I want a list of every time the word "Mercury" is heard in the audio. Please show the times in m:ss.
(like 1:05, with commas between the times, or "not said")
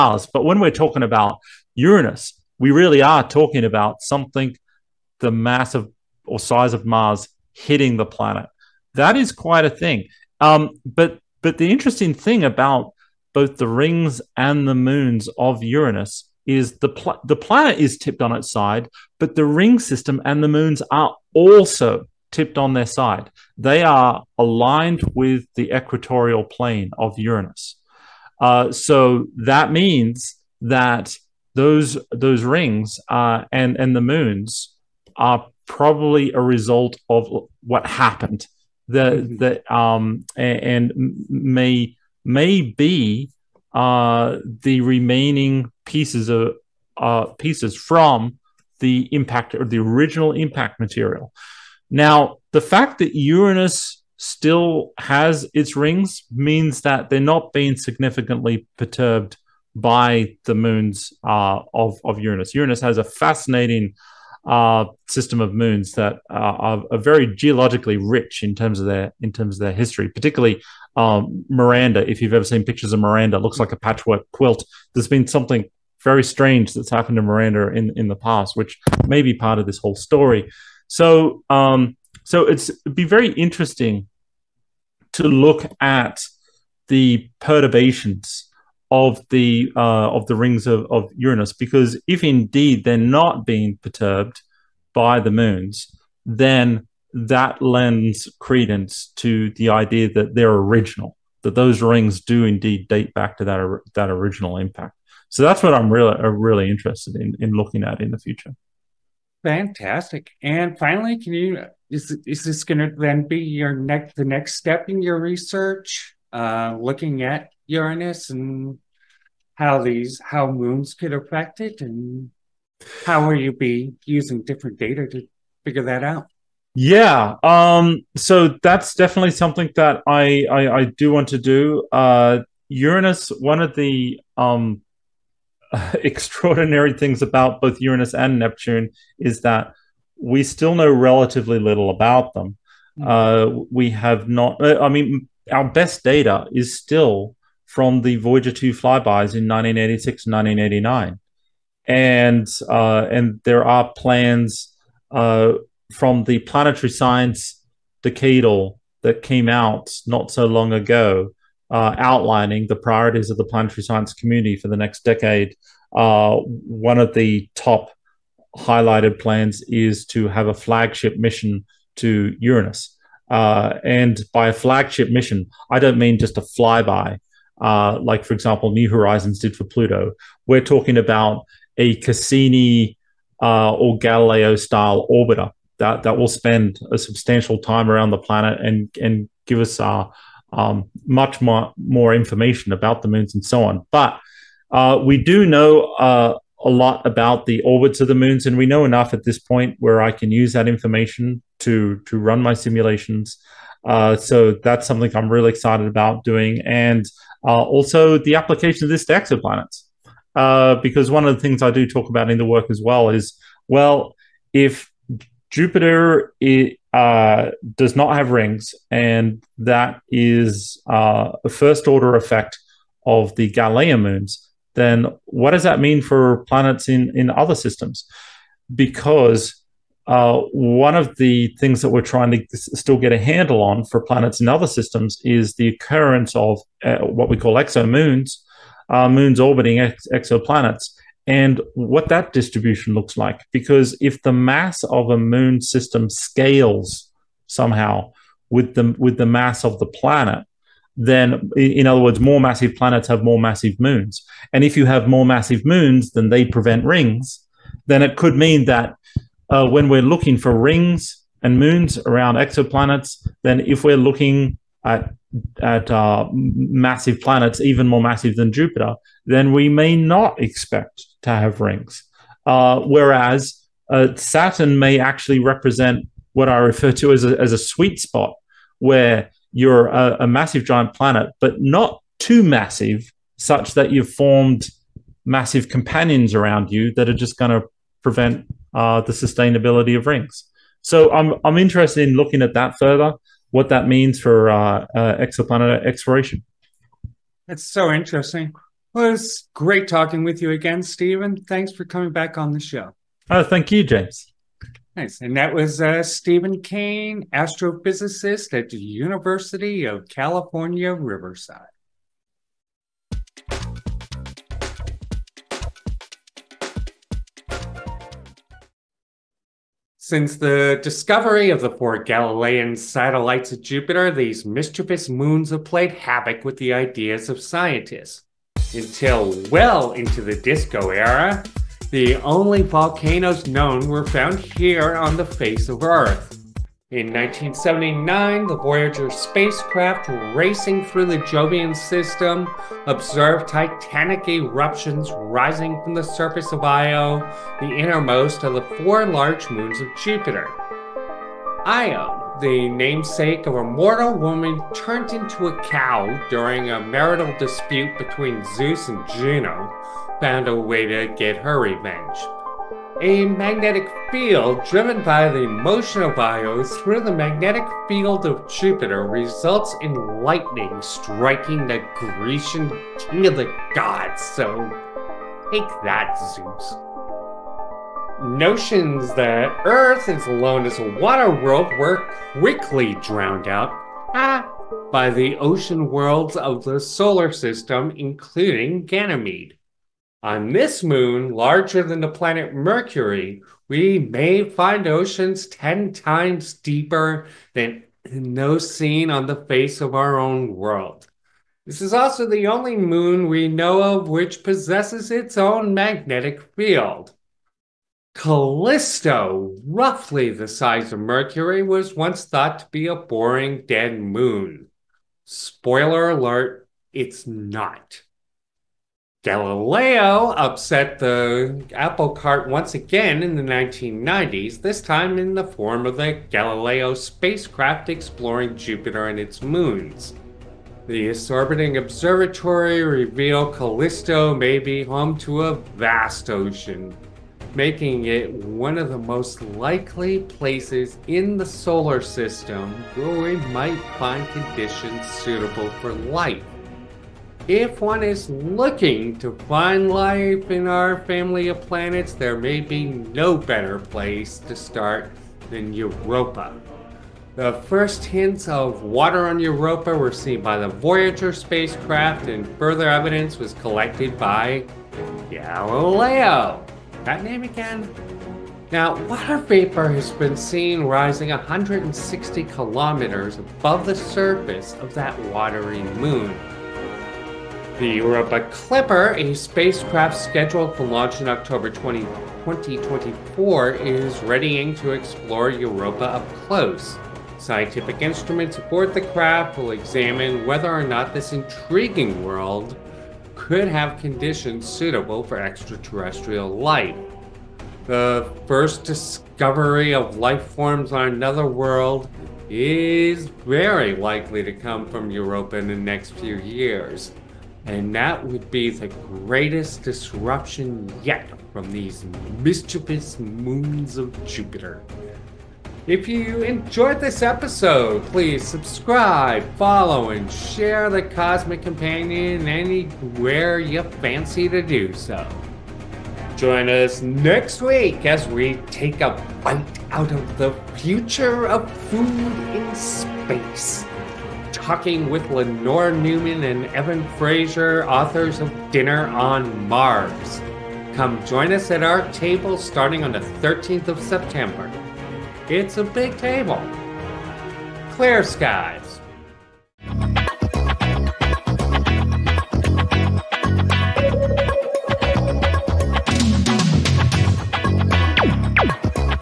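6:32, 6:50.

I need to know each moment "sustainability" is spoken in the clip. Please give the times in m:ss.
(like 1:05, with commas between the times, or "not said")
4:49.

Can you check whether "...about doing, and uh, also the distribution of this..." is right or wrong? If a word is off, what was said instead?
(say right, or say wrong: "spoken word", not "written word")
wrong: "application", not "distribution".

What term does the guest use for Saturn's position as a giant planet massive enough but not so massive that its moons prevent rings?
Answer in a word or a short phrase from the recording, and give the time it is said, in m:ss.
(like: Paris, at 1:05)
sweet spot, at 4:37.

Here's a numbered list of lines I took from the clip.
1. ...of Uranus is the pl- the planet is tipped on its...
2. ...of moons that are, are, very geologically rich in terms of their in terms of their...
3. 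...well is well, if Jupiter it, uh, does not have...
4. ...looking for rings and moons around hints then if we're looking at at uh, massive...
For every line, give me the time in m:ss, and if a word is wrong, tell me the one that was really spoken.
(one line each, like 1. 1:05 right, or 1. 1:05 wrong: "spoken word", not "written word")
1. 0:15 right
2. 1:05 right
3. 3:32 right
4. 4:20 wrong: "exoplanets", not "hints".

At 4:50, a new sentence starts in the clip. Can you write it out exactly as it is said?
So I'm I'm interested in looking at that further, what that means for uh, uh, exoplanet exploration.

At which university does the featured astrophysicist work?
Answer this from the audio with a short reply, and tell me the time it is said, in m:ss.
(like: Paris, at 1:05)
University of California, Riverside, at 5:08.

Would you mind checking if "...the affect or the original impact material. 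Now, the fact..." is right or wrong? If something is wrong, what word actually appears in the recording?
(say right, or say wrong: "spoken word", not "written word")
wrong: "impact", not "affect".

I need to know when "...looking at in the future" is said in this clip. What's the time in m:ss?
1:47.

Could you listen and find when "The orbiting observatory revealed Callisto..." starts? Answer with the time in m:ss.
7:10.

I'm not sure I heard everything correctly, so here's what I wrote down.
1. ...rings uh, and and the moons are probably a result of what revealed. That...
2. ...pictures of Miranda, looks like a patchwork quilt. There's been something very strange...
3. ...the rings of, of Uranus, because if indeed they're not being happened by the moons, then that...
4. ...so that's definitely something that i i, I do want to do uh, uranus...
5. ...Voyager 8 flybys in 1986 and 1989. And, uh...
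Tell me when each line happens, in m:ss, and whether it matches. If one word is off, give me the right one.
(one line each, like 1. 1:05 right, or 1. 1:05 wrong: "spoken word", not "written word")
1. 0:32 wrong: "happened", not "revealed"
2. 1:12 right
3. 1:30 wrong: "perturbed", not "happened"
4. 2:08 right
5. 2:28 wrong: "2", not "8".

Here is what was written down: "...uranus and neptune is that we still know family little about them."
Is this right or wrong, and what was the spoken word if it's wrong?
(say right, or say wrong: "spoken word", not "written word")
wrong: "relatively", not "family".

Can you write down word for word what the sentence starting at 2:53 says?
Uh, and by a flagship mission, I don't mean just a flyby, uh, like, for example, New Horizons did for Pluto.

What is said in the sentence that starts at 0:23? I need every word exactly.
They are aligned with the equatorial plane of Uranus.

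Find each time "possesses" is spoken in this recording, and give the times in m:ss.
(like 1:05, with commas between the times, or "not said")
6:44.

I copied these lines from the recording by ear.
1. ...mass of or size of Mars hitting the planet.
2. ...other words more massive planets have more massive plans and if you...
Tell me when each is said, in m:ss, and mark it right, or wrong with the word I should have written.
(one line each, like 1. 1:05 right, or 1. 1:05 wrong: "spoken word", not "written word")
1. 0:05 right
2. 4:11 wrong: "moons", not "plans".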